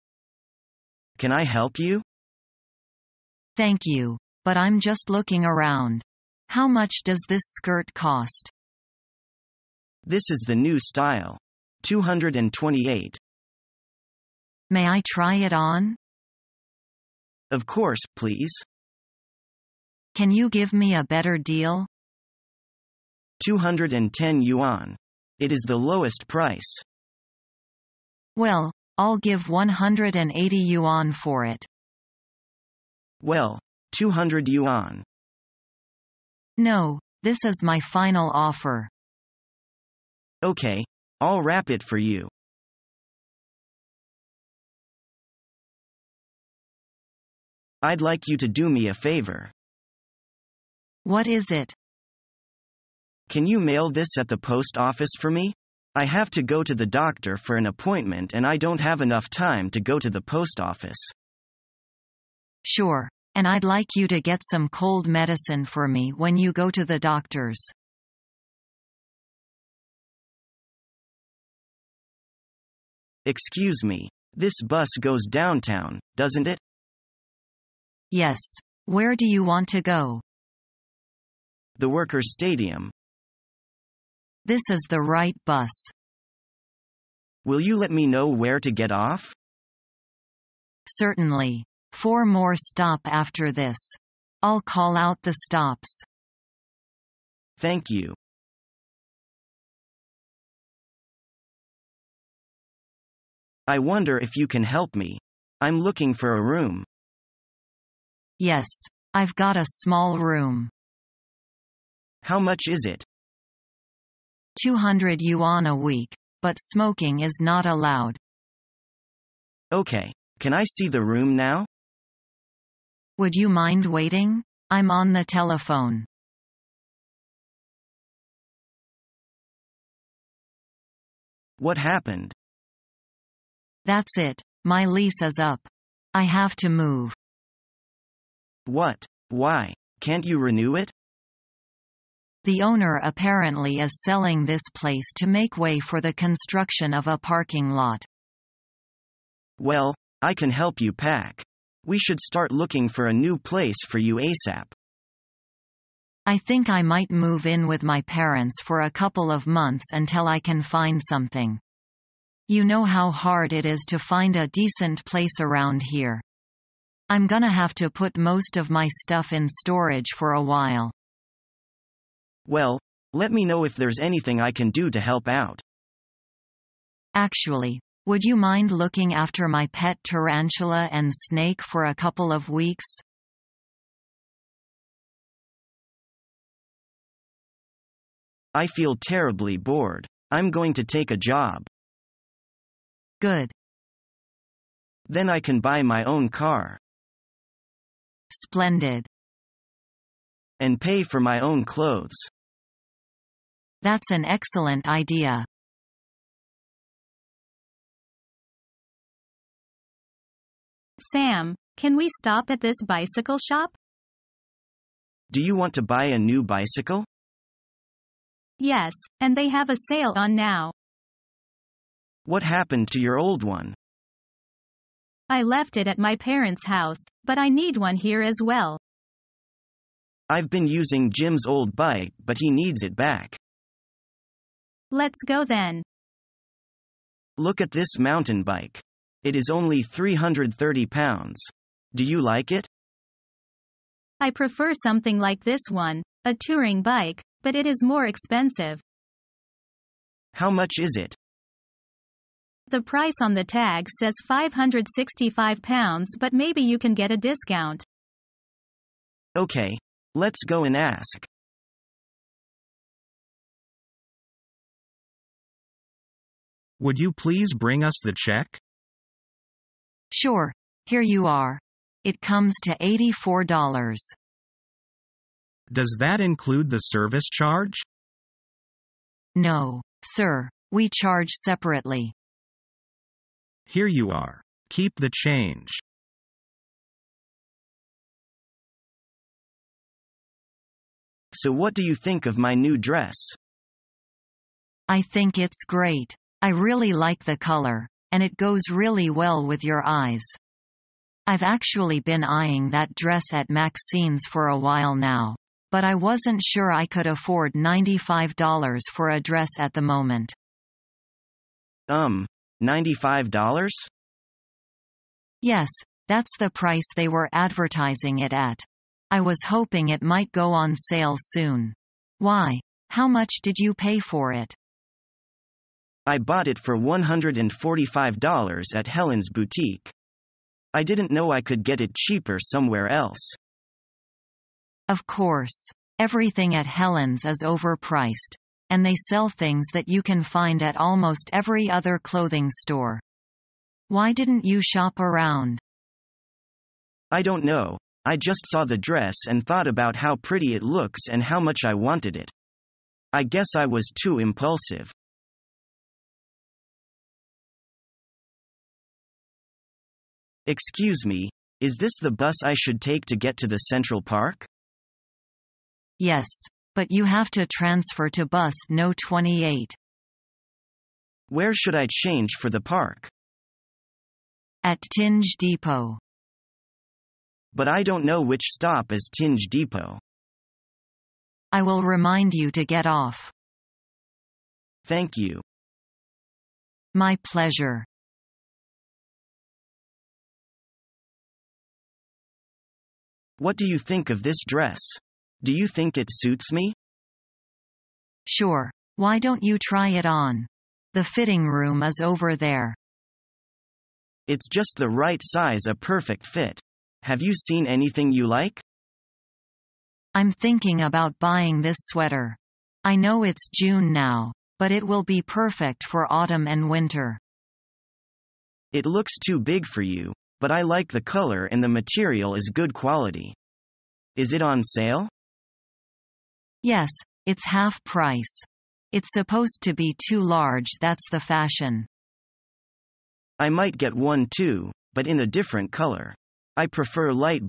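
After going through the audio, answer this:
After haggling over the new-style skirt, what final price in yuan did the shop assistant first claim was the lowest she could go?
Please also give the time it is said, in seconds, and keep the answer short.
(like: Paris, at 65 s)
210 yuan, at 23 s.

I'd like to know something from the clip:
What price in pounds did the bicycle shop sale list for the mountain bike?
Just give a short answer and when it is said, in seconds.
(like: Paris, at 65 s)
330 pounds, at 239 s.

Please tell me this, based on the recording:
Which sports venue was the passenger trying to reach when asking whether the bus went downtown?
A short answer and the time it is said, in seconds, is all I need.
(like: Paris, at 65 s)
The Workers' Stadium, at 81 s.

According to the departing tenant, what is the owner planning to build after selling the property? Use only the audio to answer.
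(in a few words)
a parking lot.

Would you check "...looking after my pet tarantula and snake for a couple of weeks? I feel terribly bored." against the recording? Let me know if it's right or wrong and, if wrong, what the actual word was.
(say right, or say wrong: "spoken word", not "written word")
right.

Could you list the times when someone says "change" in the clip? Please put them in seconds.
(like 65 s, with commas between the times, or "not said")
285 s, 371 s.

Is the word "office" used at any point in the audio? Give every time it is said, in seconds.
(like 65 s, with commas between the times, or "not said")
54 s, 60 s.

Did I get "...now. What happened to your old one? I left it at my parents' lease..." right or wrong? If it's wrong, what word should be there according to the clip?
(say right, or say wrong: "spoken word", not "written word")
wrong: "house", not "lease".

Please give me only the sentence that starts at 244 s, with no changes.
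I prefer something like this one, a touring bike, but it is more expensive.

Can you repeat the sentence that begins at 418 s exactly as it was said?
It looks too big for you but I like the color and the material is good quality.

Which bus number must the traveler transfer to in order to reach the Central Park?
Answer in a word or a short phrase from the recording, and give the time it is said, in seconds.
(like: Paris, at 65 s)
28, at 368 s.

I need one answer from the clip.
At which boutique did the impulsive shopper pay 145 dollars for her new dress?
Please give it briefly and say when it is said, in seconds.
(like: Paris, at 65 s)
Helen's boutique, at 328 s.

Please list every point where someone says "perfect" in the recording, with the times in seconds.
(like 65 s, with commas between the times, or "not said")
405 s, 415 s.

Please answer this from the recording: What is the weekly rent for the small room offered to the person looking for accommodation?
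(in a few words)
200 yuan a week.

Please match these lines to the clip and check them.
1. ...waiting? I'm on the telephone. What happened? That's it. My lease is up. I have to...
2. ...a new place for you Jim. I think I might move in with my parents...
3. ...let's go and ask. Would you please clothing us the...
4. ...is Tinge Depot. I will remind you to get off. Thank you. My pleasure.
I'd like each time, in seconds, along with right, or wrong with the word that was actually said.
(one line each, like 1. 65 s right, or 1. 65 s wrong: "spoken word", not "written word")
1. 123 s right
2. 153 s wrong: "ASAP", not "Jim"
3. 260 s wrong: "bring", not "clothing"
4. 378 s right.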